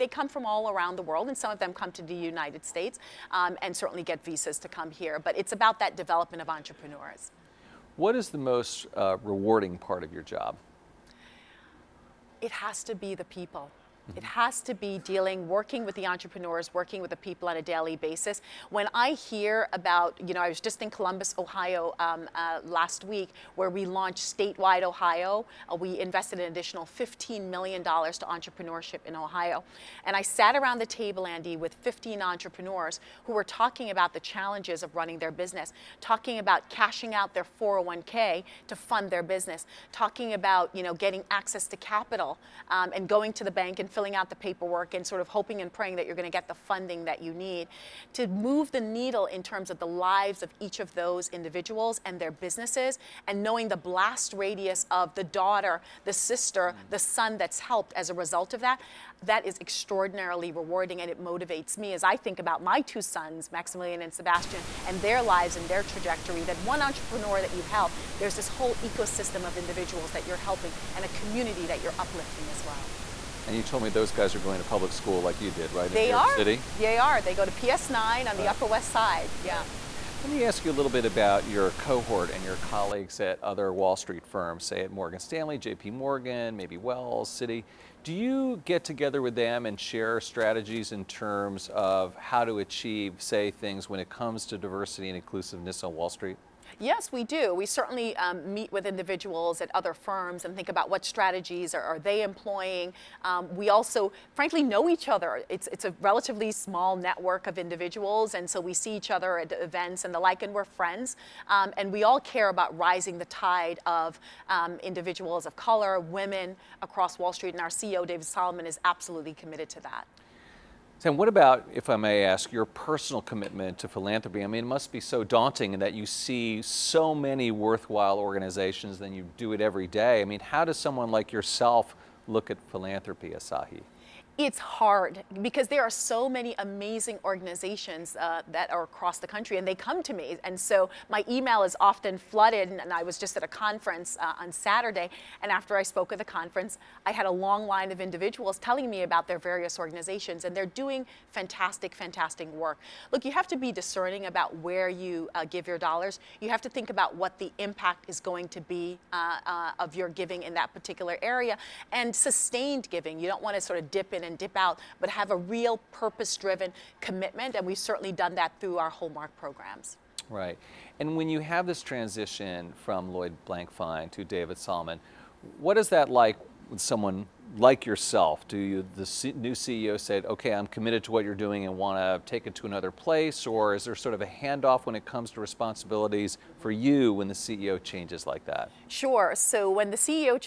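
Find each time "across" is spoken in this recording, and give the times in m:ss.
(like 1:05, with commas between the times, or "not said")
1:56, 2:18.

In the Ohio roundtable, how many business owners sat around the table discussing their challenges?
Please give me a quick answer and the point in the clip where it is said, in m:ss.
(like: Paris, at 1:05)
15, at 0:31.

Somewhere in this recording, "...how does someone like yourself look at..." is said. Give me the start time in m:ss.
2:10.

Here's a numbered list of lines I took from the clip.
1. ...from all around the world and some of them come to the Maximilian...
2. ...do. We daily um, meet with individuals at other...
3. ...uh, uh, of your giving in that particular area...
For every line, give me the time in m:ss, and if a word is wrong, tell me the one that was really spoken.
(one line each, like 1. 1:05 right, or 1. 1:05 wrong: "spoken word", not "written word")
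1. 0:00 wrong: "United", not "Maximilian"
2. 1:37 wrong: "certainly", not "daily"
3. 2:39 right.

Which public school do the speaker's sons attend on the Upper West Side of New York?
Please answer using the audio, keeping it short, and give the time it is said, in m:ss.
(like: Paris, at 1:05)
PS9, at 1:17.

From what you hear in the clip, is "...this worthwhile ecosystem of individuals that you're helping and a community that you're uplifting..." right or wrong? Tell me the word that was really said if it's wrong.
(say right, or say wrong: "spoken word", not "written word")
wrong: "whole", not "worthwhile".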